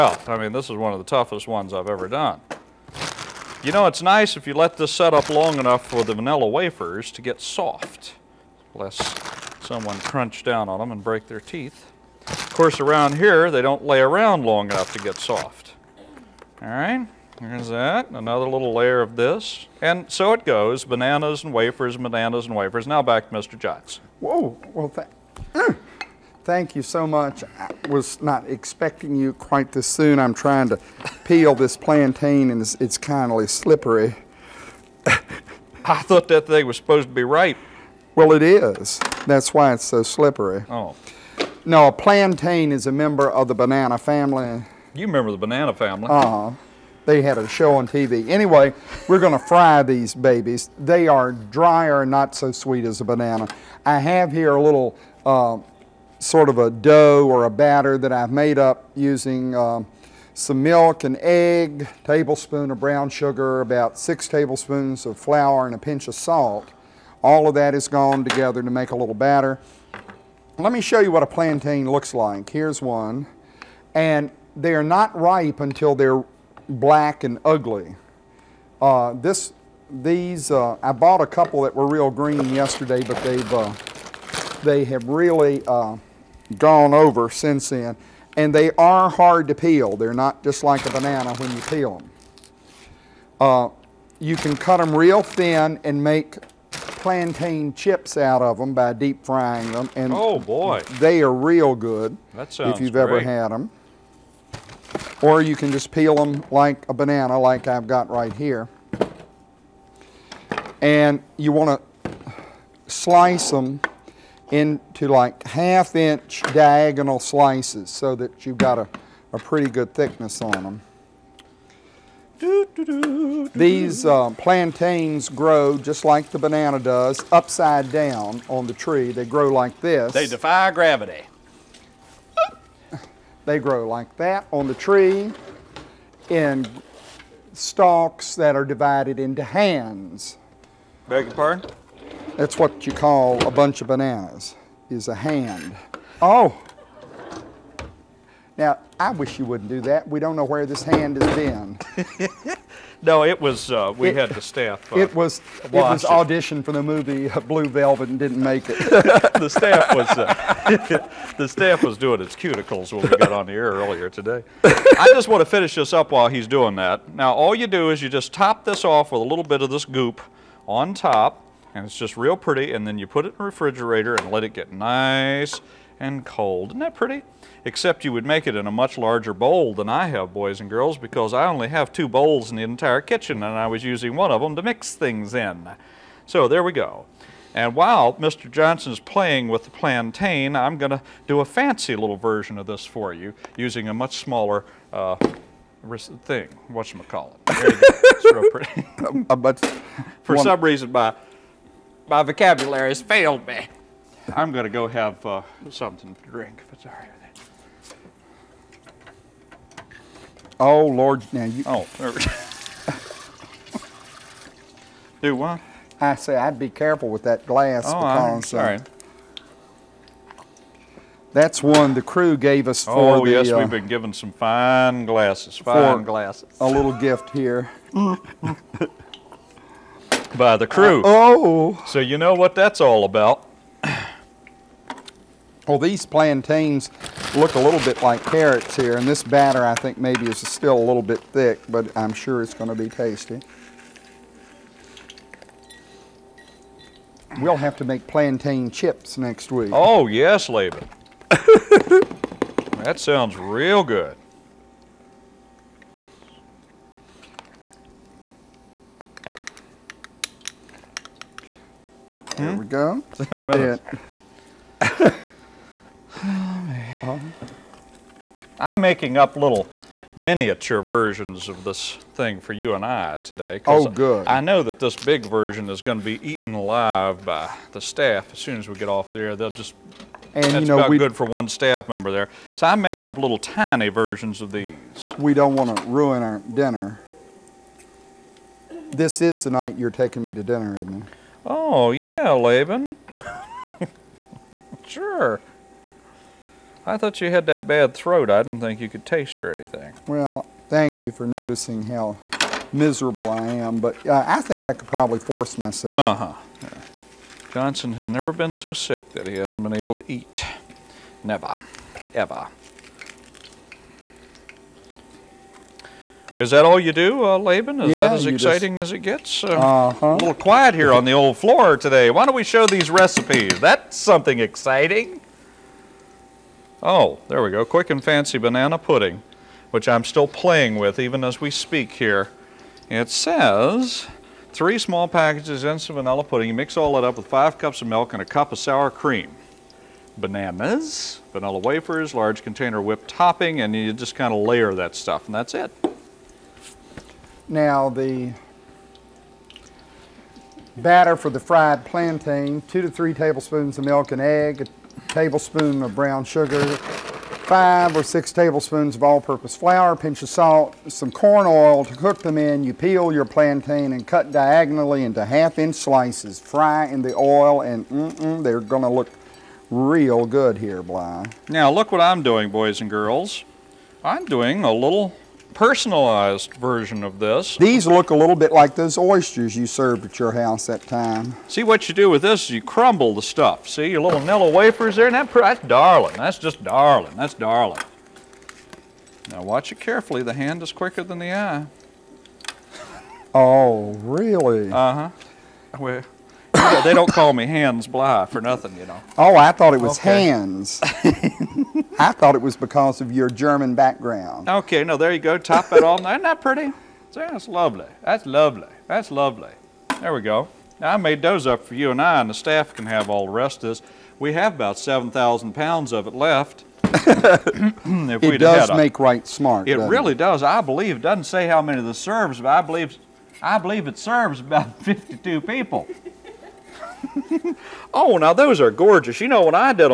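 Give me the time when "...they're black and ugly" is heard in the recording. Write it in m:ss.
1:15.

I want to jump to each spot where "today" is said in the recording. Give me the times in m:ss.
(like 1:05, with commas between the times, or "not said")
2:44, 4:33, 5:21.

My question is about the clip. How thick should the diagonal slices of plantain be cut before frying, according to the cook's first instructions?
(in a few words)
half inch.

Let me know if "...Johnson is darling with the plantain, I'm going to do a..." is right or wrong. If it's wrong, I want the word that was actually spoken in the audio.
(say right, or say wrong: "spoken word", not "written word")
wrong: "playing", not "darling".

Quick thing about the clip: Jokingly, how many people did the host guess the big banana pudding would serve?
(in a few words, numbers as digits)
52.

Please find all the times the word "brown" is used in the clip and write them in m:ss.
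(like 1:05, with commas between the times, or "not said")
1:02, 5:55.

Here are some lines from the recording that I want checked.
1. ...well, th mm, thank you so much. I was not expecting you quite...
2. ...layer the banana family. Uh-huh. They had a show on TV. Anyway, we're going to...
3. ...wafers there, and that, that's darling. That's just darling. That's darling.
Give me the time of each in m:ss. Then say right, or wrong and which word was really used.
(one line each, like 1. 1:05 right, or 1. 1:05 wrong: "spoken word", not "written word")
1. 0:24 right
2. 0:45 wrong: "remember", not "layer"
3. 6:24 right.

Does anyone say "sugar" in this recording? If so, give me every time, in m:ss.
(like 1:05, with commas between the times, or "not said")
1:03, 5:56.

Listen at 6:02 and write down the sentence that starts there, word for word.
You peel your plantain and cut diagonally into half-inch slices.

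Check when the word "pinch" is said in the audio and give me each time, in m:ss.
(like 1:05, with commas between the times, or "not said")
1:05, 5:59.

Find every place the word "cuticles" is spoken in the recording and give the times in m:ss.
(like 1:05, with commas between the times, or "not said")
2:42.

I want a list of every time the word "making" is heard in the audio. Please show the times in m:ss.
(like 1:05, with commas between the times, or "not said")
4:28, 4:42.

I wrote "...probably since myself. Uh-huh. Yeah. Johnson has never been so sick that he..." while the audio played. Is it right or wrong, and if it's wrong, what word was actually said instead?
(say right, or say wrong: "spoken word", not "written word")
wrong: "force", not "since".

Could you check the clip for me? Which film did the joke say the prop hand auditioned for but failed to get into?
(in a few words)
Blue Velvet.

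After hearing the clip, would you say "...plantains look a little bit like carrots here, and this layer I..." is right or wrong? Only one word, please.
wrong.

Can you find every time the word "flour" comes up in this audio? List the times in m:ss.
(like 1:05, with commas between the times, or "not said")
1:05, 5:59.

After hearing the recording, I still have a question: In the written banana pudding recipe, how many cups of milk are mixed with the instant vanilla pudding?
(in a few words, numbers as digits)
5 cups.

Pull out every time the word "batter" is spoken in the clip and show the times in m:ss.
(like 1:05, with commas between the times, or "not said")
0:57, 1:09, 3:59, 5:50.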